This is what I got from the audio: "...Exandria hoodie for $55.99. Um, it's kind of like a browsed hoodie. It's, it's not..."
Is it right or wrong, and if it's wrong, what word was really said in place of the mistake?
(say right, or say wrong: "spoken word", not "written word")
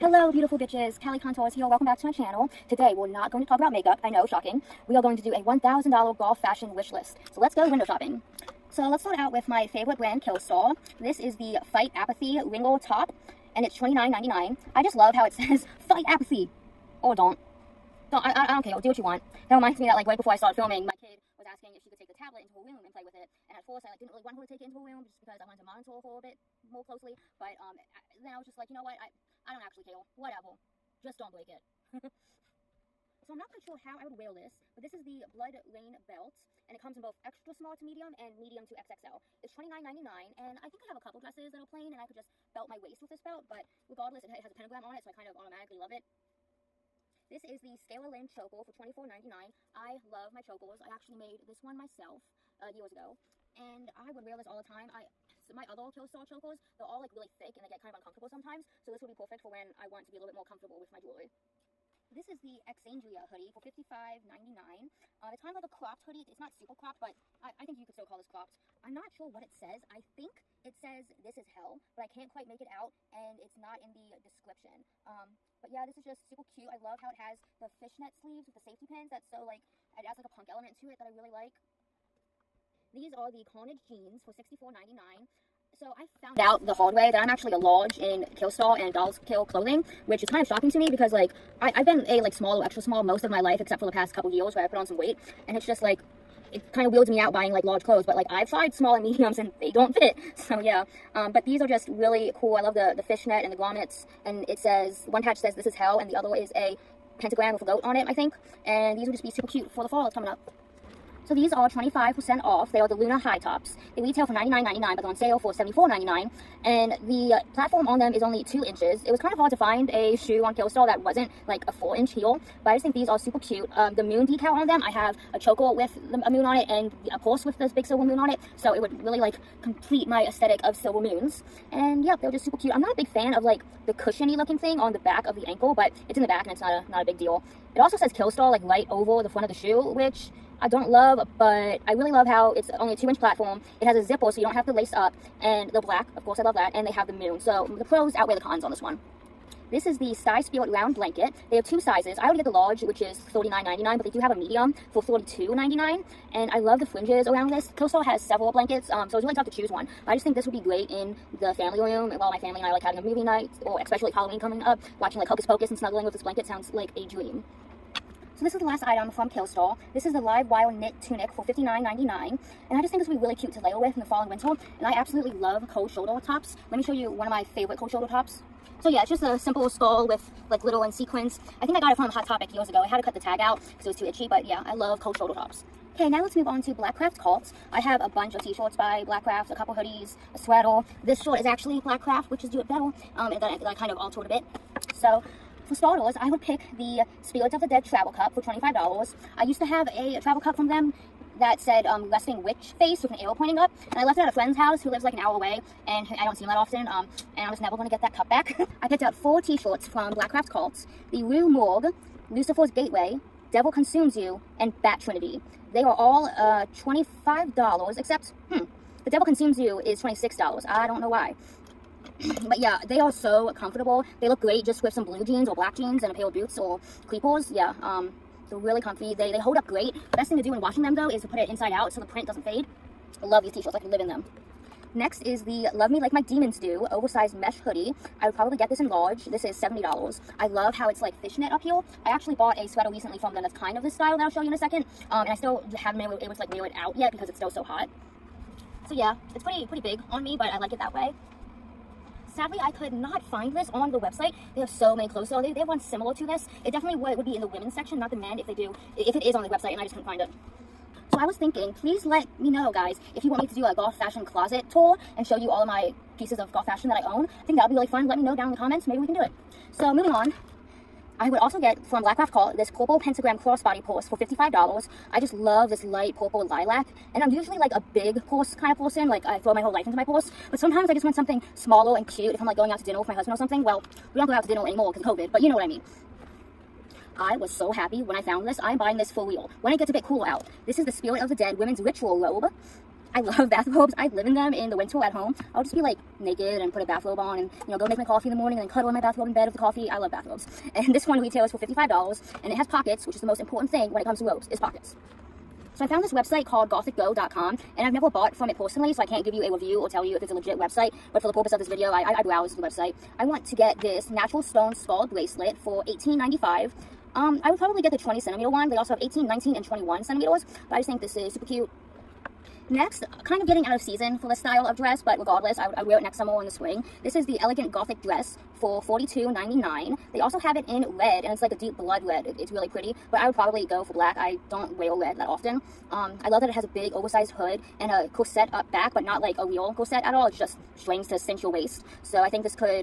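wrong: "cropped", not "browsed".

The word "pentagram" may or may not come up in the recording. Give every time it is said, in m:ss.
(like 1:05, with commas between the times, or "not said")
0:44, 1:47, 4:32.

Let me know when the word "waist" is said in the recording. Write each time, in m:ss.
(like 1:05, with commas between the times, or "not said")
0:42, 5:41.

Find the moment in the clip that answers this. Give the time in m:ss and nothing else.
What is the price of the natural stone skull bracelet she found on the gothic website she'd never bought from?
5:15.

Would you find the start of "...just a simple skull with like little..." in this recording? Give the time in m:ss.
2:59.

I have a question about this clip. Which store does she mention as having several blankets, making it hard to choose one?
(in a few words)
Costco.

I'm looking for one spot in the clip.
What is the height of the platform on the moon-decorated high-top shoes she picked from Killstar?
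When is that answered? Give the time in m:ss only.
1:58.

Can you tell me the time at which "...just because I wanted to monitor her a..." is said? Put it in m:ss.
0:25.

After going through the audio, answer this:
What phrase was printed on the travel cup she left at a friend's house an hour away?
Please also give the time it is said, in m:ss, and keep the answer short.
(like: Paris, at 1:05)
resting witch face, at 3:22.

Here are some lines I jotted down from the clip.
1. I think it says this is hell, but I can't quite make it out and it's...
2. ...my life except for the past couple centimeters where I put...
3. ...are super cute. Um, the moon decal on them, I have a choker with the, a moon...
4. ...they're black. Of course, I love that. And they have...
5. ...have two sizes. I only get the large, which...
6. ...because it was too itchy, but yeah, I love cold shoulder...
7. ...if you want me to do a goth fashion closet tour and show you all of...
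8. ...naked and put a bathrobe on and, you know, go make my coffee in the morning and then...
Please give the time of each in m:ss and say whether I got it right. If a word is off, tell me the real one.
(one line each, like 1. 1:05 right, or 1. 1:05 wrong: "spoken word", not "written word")
1. 1:09 right
2. 1:33 wrong: "years", not "centimeters"
3. 2:03 right
4. 2:25 right
5. 2:31 right
6. 3:03 right
7. 4:23 right
8. 4:56 right.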